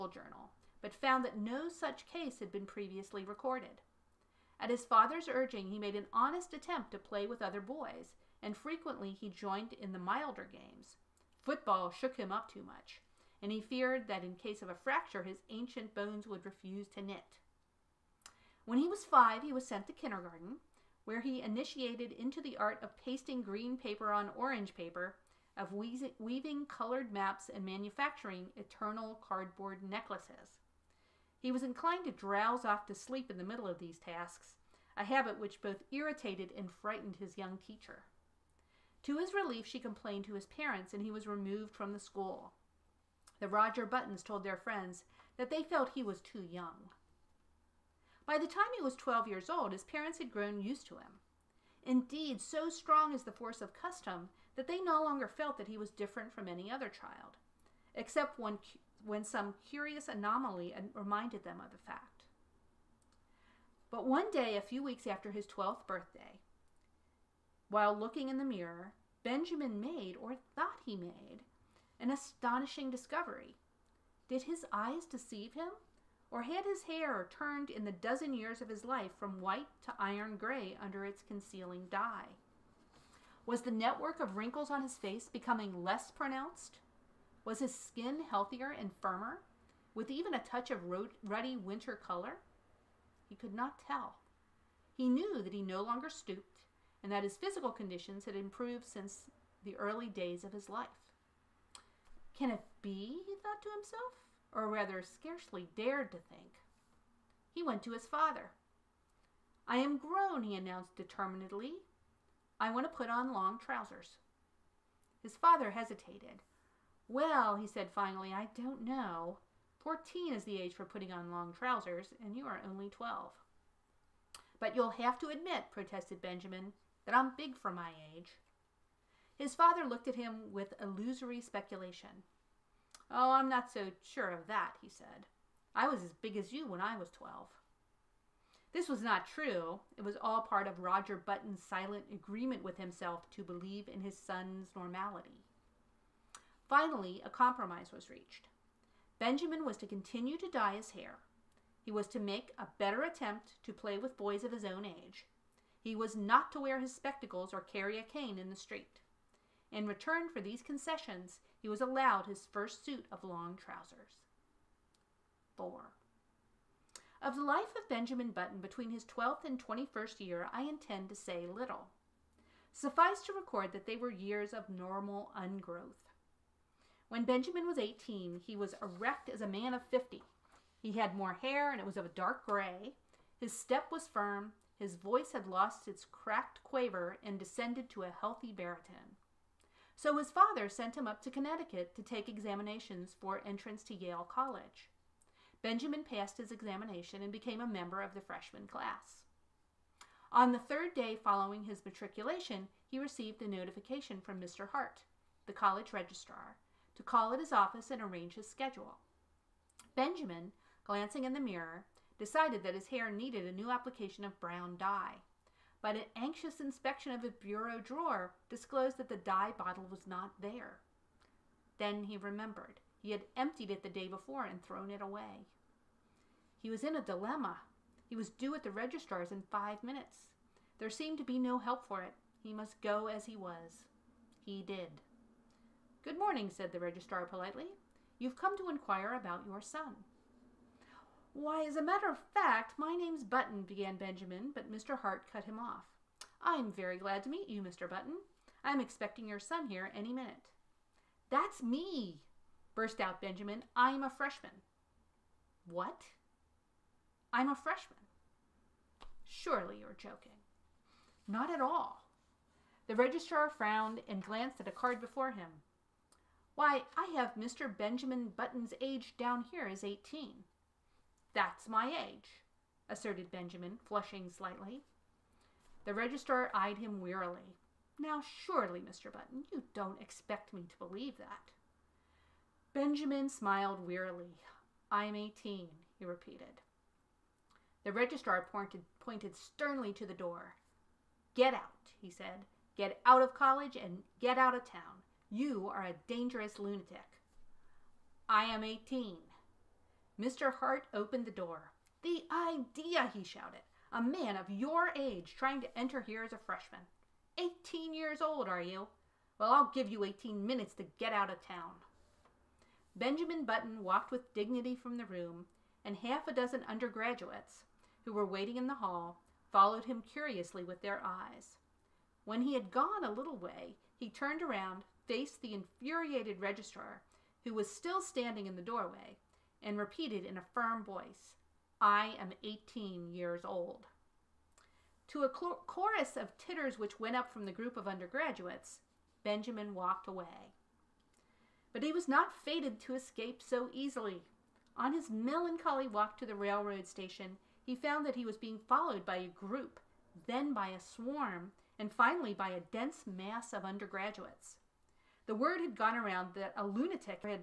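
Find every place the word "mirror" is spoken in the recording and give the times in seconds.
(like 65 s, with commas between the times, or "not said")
68 s, 211 s.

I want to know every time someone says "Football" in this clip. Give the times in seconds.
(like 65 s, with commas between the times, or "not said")
11 s.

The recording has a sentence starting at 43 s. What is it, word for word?
The Roger Buttons told their friends that they felt he was too young.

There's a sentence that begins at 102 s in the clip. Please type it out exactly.
Can it be, he thought to himself, or rather scarcely dared to think.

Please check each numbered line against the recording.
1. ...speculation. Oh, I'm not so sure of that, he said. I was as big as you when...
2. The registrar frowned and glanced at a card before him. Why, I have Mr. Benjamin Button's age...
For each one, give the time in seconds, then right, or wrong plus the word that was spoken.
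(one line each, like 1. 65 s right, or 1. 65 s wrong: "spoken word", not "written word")
1. 131 s right
2. 262 s right.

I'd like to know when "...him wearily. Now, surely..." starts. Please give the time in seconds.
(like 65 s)
276 s.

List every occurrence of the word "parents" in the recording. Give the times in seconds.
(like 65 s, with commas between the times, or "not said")
40 s, 49 s.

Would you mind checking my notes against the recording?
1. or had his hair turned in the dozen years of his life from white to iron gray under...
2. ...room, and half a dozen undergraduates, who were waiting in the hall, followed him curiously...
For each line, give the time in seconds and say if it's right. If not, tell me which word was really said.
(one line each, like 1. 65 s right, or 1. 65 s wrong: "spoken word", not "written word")
1. 76 s right
2. 315 s right.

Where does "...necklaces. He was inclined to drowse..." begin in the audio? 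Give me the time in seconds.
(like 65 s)
29 s.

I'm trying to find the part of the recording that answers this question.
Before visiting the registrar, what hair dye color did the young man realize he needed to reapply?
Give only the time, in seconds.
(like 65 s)
214 s.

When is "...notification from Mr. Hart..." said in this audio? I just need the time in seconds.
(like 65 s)
203 s.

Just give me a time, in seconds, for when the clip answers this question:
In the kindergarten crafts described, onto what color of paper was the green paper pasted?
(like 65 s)
24 s.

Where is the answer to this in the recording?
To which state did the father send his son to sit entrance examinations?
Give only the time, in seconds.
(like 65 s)
191 s.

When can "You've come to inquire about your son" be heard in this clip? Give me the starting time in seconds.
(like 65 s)
238 s.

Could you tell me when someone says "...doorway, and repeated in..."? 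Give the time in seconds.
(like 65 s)
328 s.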